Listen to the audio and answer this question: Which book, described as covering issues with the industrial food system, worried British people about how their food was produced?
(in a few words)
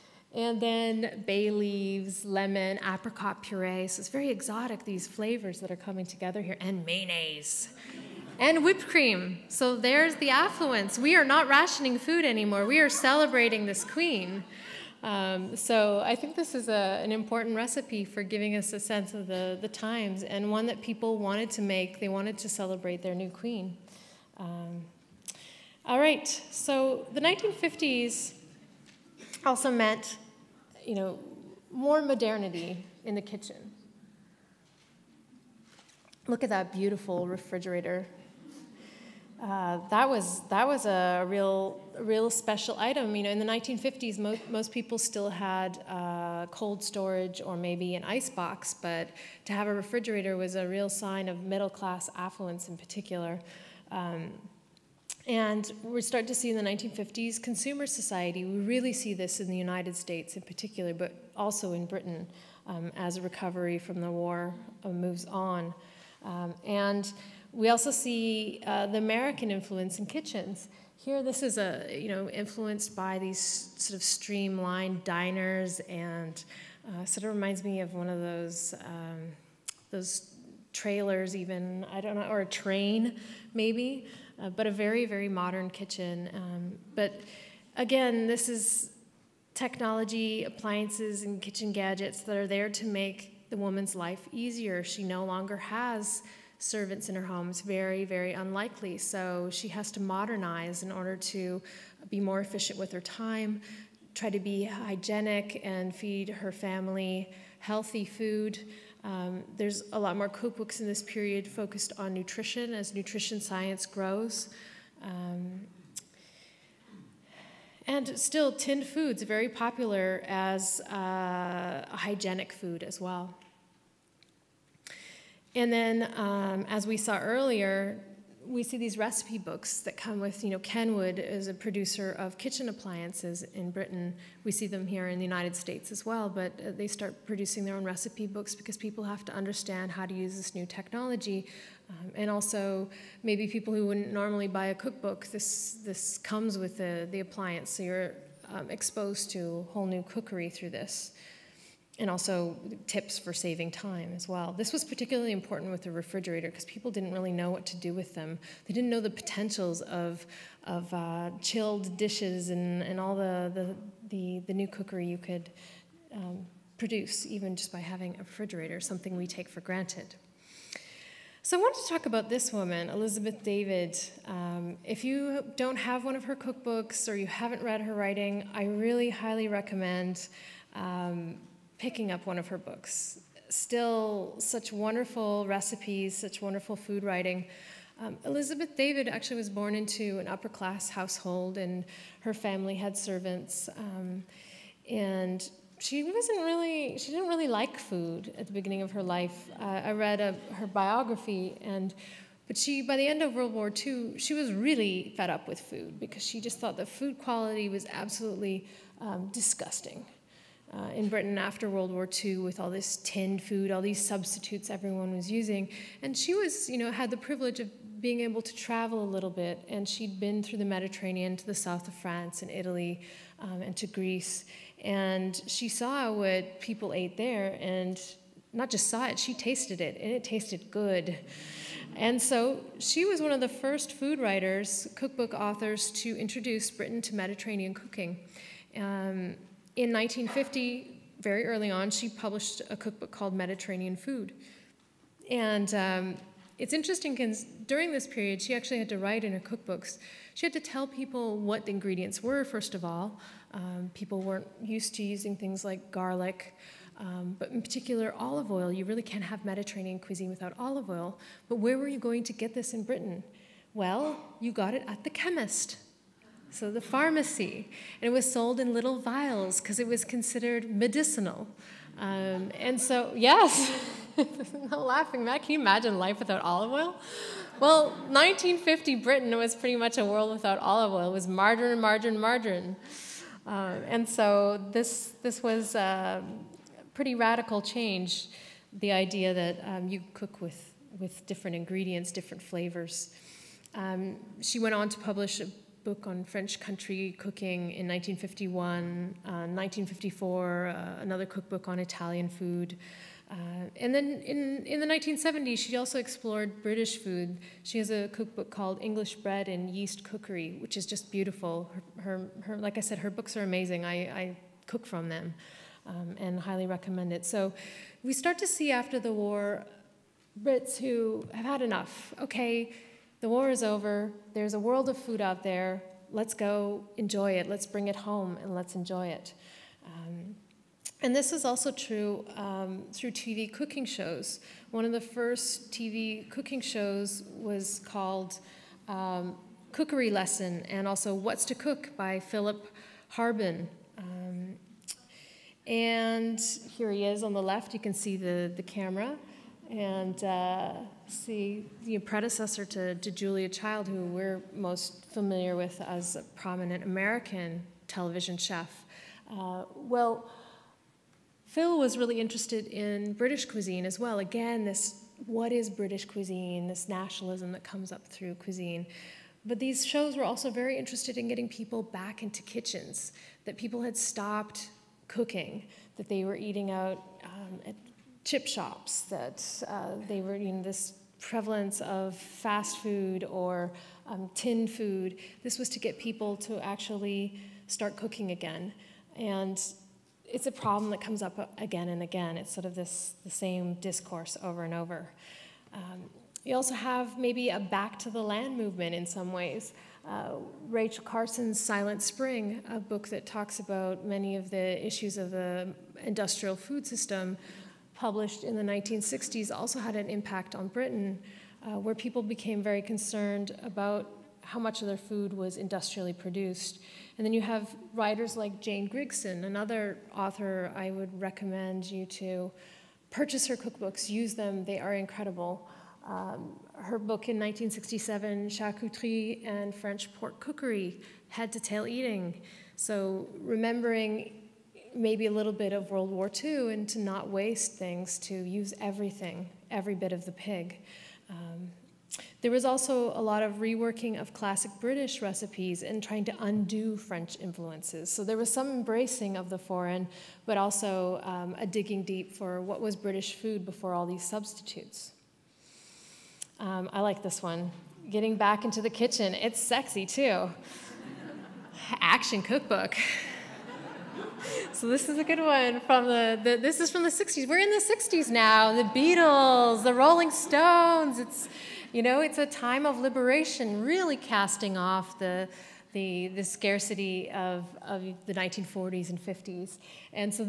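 Silent Spring.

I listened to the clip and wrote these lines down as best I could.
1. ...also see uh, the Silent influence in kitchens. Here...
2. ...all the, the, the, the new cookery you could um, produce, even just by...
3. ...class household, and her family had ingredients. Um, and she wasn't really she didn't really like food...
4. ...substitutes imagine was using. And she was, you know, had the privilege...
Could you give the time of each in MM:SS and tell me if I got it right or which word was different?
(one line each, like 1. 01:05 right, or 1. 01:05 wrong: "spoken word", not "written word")
1. 01:07 wrong: "American", not "Silent"
2. 02:43 right
3. 03:10 wrong: "servants", not "ingredients"
4. 03:34 wrong: "everyone", not "imagine".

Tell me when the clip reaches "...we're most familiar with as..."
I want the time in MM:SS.
05:54.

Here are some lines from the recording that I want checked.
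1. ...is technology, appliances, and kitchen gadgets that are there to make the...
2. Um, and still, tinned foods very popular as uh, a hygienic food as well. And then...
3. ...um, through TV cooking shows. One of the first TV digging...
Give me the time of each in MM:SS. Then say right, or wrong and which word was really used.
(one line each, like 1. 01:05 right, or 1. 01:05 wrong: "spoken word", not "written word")
1. 01:28 right
2. 01:55 right
3. 05:32 wrong: "cooking", not "digging".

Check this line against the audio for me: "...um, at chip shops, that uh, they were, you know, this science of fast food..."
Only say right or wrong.
wrong.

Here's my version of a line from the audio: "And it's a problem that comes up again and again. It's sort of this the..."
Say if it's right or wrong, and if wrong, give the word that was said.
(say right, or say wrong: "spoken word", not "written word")
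right.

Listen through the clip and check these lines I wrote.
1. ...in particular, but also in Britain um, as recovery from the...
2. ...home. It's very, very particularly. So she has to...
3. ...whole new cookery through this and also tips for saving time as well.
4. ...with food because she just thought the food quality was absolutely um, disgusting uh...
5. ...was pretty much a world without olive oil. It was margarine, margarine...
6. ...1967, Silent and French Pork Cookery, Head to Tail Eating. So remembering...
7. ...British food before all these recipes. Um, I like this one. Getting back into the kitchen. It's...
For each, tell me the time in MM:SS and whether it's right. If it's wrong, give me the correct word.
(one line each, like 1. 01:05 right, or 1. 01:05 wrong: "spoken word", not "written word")
1. 01:00 right
2. 01:37 wrong: "unlikely", not "particularly"
3. 02:29 right
4. 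03:25 right
5. 04:39 right
6. 07:07 wrong: "Charcuterie", not "Silent"
7. 07:32 wrong: "substitutes", not "recipes".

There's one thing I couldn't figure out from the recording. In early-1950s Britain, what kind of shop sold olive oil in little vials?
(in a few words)
The chemist.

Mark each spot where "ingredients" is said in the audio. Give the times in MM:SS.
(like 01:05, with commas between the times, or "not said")
04:11, 04:51.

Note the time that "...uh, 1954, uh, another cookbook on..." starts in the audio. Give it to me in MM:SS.
04:59.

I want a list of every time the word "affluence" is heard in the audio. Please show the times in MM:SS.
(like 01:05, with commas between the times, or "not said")
00:10, 00:52.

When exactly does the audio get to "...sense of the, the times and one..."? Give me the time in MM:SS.
00:18.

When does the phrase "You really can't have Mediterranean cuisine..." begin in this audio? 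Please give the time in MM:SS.
04:18.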